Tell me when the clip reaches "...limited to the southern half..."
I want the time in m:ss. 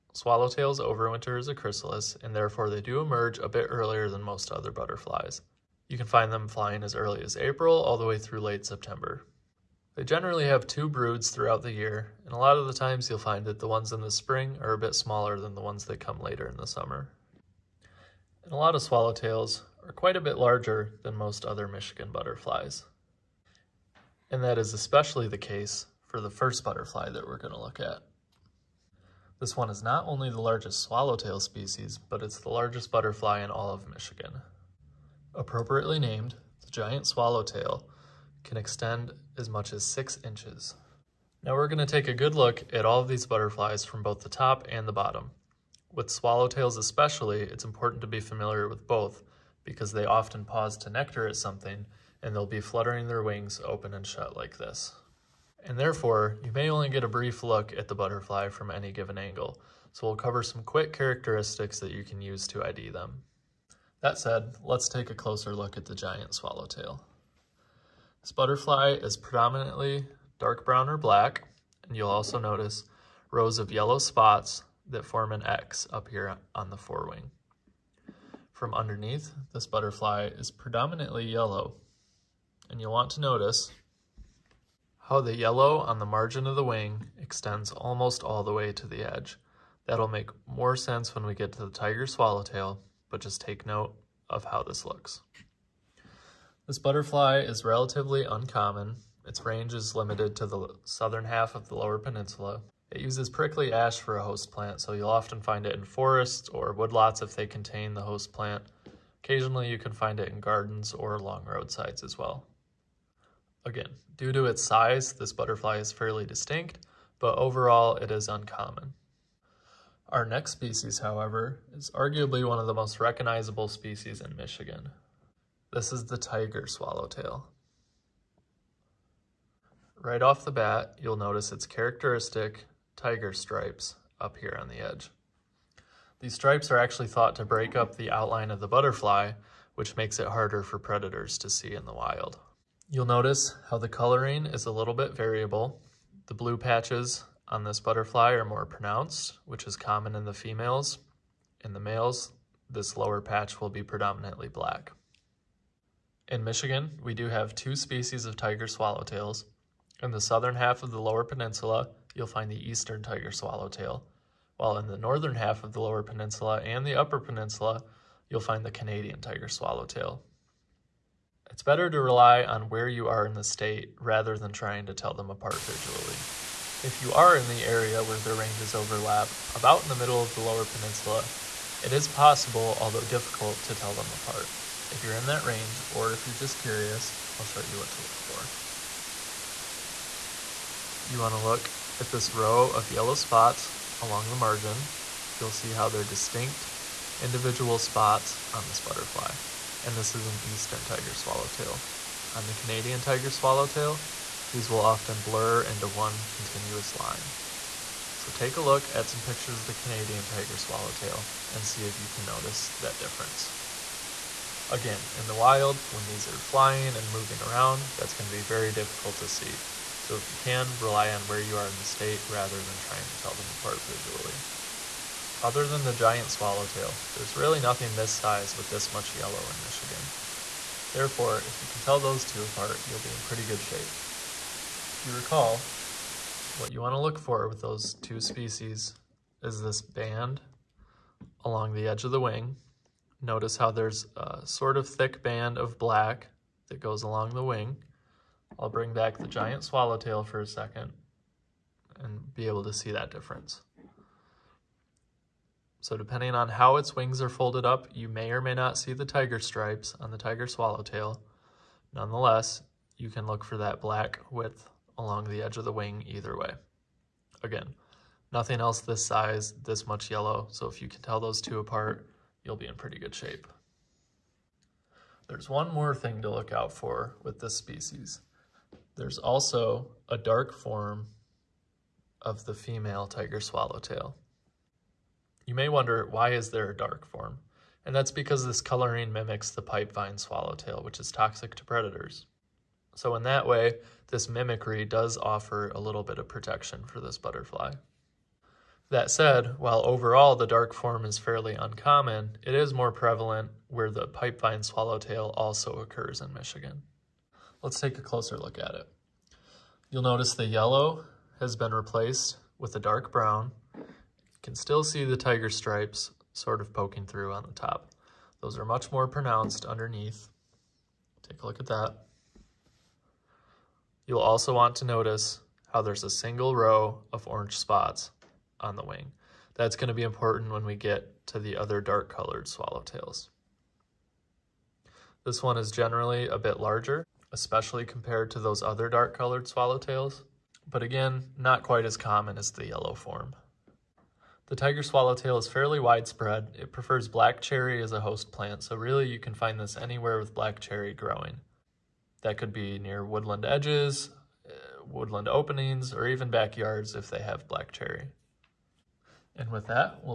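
1:39.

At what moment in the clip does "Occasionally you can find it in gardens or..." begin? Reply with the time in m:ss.
1:49.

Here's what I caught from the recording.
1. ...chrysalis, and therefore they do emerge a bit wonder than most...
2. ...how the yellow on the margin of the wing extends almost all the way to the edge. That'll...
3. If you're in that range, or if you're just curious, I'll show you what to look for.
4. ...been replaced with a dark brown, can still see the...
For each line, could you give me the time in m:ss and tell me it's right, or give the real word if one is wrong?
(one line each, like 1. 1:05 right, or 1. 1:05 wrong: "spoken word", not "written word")
1. 0:01 wrong: "earlier", not "wonder"
2. 1:25 right
3. 3:04 right
4. 5:11 right.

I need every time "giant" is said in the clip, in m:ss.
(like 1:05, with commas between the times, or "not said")
0:36, 1:05, 3:45, 4:09.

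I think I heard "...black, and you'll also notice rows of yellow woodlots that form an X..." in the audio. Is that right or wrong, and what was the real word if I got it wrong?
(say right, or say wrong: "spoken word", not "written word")
wrong: "spots", not "woodlots".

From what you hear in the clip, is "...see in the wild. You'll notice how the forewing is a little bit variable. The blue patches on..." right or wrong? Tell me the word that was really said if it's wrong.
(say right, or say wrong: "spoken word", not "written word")
wrong: "coloring", not "forewing".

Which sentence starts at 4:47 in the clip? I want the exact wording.
And that's because this coloring mimics the pipevine swallowtail, which is toxic to predators.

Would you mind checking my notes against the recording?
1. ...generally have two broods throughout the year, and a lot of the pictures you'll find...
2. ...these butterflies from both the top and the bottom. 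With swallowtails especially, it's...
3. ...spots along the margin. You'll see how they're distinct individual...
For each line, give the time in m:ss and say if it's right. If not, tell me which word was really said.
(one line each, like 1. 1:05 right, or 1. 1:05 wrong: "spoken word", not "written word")
1. 0:10 wrong: "times", not "pictures"
2. 0:43 right
3. 3:13 right.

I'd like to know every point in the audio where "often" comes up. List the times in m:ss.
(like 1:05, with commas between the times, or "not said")
0:50, 1:45, 3:24.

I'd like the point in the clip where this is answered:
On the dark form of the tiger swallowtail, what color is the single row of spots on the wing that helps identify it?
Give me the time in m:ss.
5:27.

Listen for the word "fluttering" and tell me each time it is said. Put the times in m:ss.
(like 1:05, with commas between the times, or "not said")
0:52.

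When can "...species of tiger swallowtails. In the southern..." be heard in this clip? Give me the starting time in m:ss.
2:37.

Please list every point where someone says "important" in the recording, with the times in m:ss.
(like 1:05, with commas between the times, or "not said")
0:47, 5:30.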